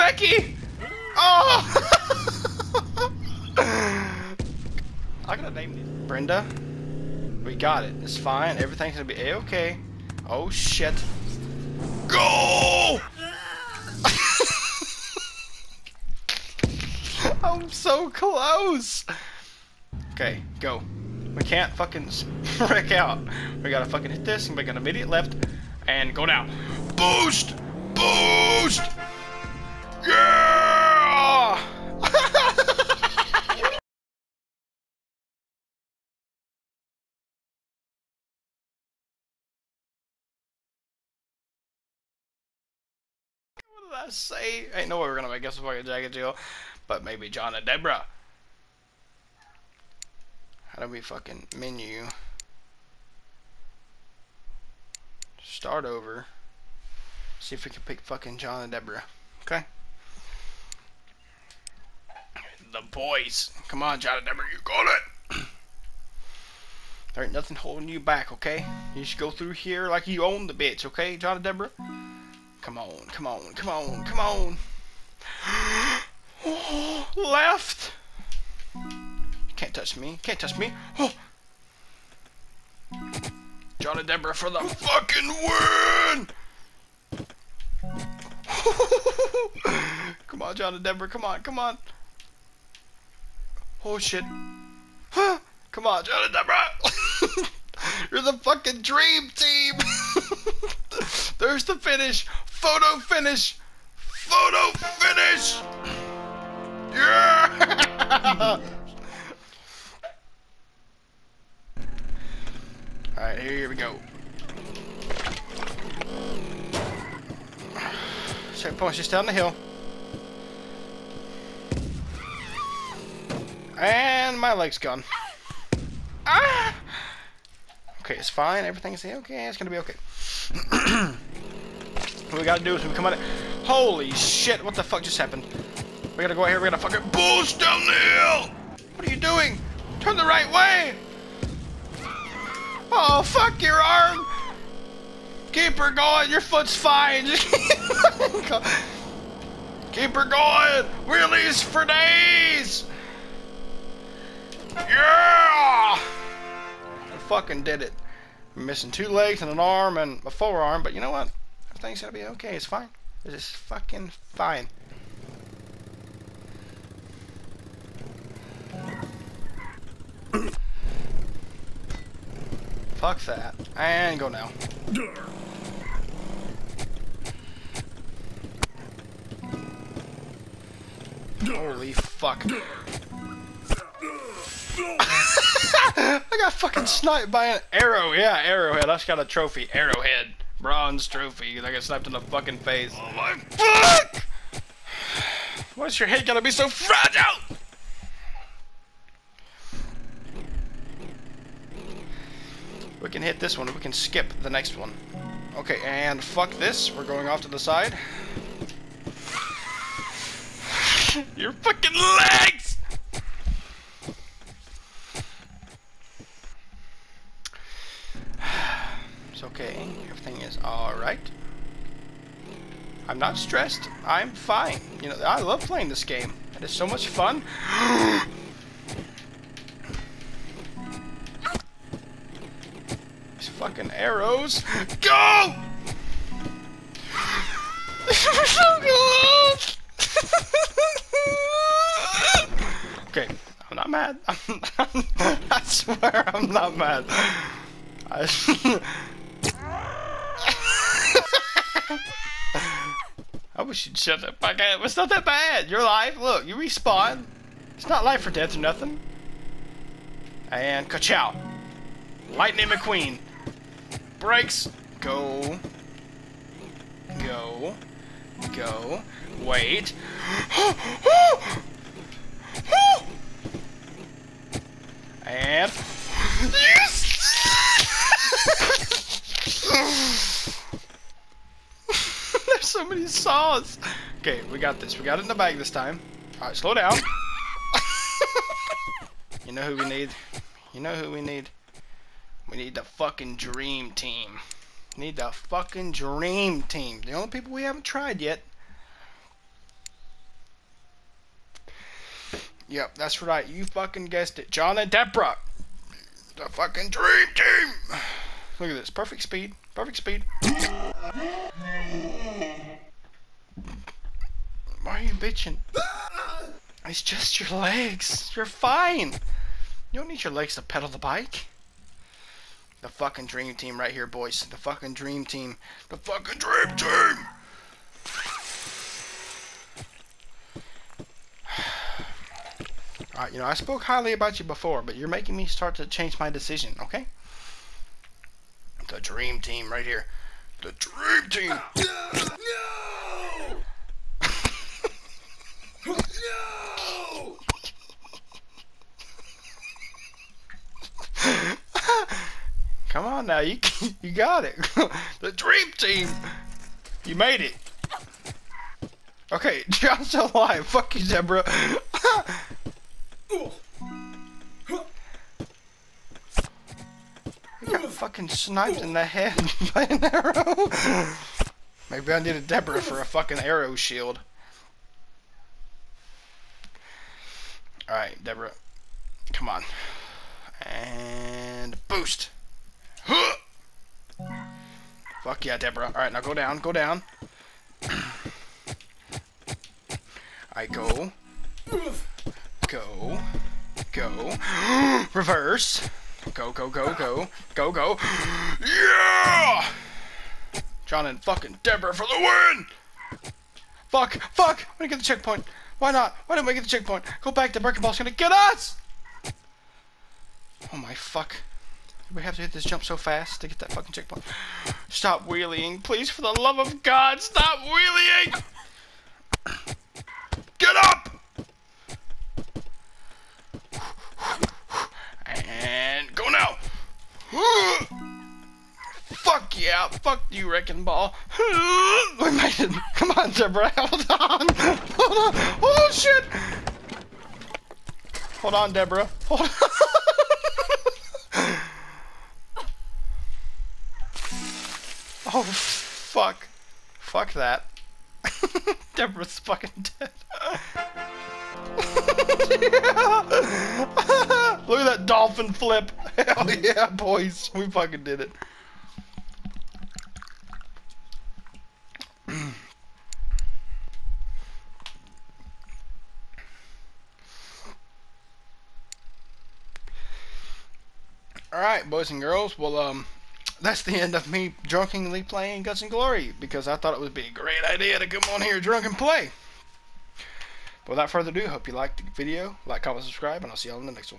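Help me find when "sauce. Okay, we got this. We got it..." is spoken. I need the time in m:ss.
4:43.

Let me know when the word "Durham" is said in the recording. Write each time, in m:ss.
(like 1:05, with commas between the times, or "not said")
not said.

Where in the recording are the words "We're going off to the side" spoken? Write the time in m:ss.
3:26.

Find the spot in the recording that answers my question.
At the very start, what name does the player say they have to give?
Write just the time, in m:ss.
0:06.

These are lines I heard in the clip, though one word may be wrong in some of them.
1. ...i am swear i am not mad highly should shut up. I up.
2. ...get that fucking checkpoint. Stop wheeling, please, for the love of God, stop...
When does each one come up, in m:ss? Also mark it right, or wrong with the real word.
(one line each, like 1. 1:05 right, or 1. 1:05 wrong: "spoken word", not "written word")
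1. 4:08 wrong: "probably", not "highly"
2. 6:53 right.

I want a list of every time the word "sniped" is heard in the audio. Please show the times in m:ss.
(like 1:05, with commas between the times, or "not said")
3:06, 6:08.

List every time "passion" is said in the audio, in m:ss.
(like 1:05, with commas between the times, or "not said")
not said.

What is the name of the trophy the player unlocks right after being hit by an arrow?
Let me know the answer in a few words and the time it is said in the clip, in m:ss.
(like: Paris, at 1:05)
Arrowhead bronze trophy, at 3:09.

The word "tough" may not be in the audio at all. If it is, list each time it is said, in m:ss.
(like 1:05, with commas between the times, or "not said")
not said.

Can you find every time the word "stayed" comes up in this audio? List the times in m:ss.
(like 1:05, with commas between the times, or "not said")
not said.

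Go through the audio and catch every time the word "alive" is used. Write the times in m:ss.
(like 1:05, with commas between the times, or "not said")
6:00.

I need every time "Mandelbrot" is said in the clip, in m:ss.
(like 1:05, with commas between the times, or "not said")
not said.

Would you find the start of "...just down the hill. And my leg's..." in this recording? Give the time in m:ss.
1:58.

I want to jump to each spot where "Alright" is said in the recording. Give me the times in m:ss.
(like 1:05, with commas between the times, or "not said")
1:53, 5:33, 6:17, 6:25.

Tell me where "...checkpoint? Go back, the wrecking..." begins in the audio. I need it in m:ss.
6:46.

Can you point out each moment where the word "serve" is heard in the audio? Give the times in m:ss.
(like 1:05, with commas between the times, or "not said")
not said.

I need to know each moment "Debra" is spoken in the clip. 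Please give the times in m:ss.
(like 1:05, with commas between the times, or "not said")
5:04.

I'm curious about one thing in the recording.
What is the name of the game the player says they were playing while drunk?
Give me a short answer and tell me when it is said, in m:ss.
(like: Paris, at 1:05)
Guts and Glory, at 7:55.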